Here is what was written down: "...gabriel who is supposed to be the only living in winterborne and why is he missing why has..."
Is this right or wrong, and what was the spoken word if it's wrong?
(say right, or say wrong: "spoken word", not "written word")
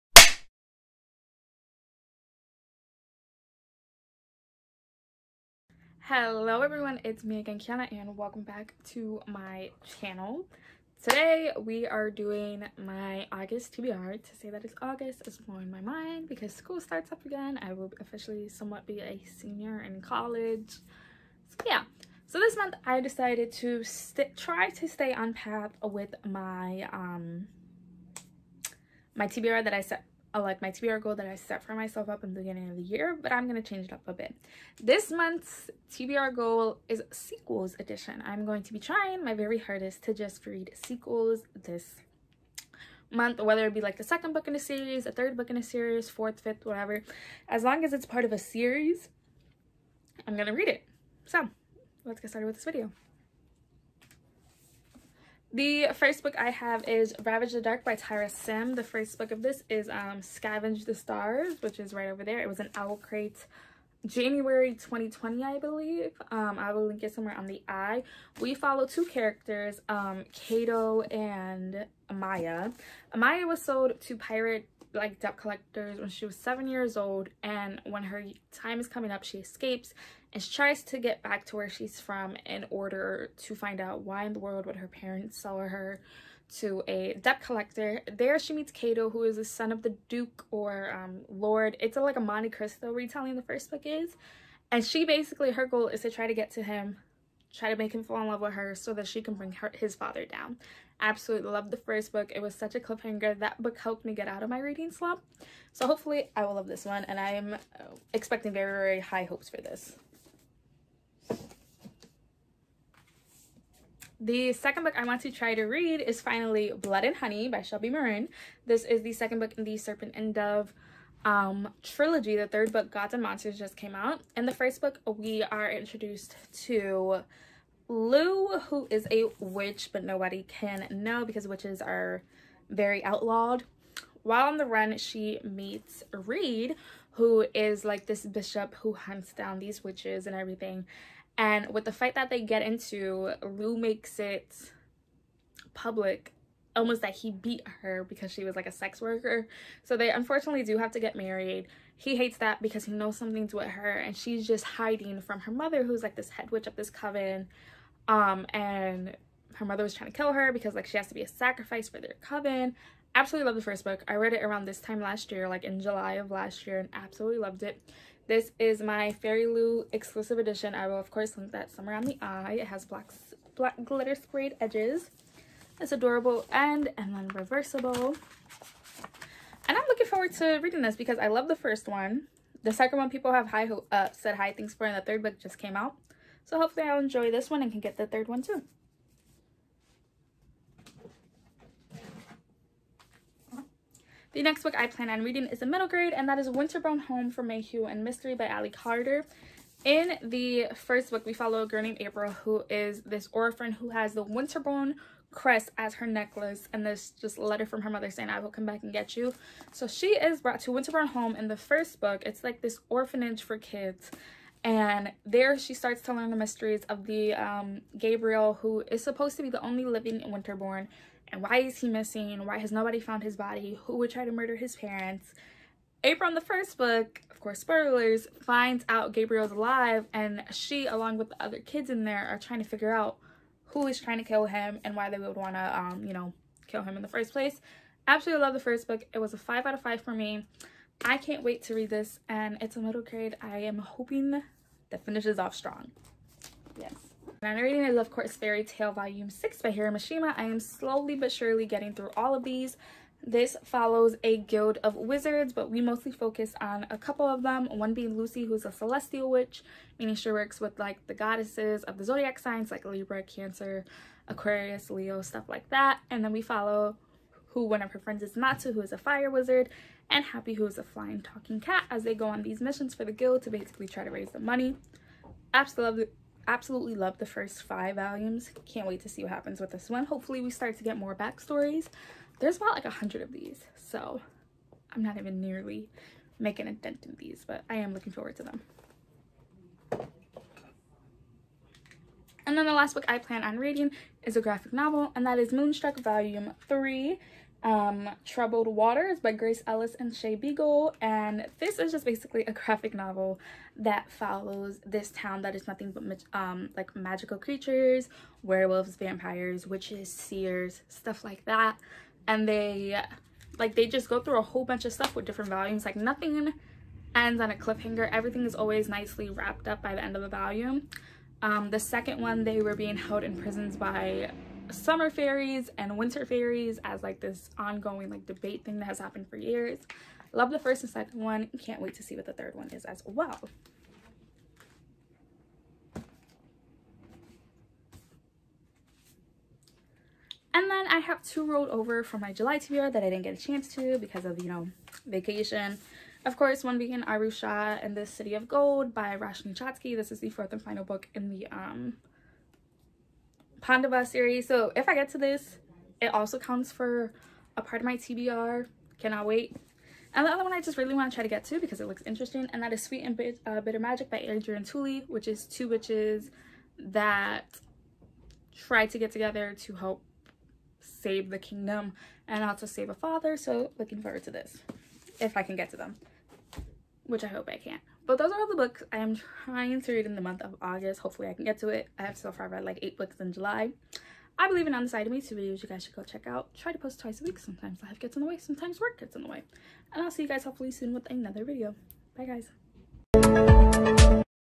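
right.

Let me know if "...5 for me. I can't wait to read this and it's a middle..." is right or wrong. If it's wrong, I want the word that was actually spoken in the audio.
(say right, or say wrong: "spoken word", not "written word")
right.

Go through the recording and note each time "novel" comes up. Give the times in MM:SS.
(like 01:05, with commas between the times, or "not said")
04:54, 05:02.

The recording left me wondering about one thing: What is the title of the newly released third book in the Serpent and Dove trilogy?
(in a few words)
Gods and Monsters.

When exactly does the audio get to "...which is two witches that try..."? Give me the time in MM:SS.
06:05.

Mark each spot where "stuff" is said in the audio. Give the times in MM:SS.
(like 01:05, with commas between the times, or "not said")
04:25, 05:10, 05:14.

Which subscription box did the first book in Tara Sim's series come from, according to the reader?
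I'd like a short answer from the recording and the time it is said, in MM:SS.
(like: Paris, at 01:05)
OwlCrate, at 01:02.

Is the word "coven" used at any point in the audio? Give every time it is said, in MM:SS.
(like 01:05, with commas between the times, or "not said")
02:36, 02:42.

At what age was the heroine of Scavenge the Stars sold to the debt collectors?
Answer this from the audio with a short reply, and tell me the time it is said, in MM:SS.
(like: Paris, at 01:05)
7, at 01:16.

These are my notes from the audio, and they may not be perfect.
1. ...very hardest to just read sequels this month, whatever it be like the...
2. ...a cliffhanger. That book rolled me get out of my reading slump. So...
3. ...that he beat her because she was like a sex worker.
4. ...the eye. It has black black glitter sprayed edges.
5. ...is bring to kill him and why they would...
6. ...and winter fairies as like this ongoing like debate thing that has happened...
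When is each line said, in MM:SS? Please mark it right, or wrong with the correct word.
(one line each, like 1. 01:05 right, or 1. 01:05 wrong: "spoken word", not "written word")
1. 00:39 wrong: "whether", not "whatever"
2. 01:42 wrong: "helped", not "rolled"
3. 02:27 right
4. 02:52 right
5. 03:53 wrong: "trying", not "bring"
6. 05:25 right.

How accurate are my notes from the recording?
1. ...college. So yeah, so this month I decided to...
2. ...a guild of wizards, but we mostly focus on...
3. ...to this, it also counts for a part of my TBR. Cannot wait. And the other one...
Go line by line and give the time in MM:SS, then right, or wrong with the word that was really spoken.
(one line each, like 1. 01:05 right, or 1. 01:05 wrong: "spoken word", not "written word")
1. 00:20 right
2. 04:14 right
3. 05:55 right.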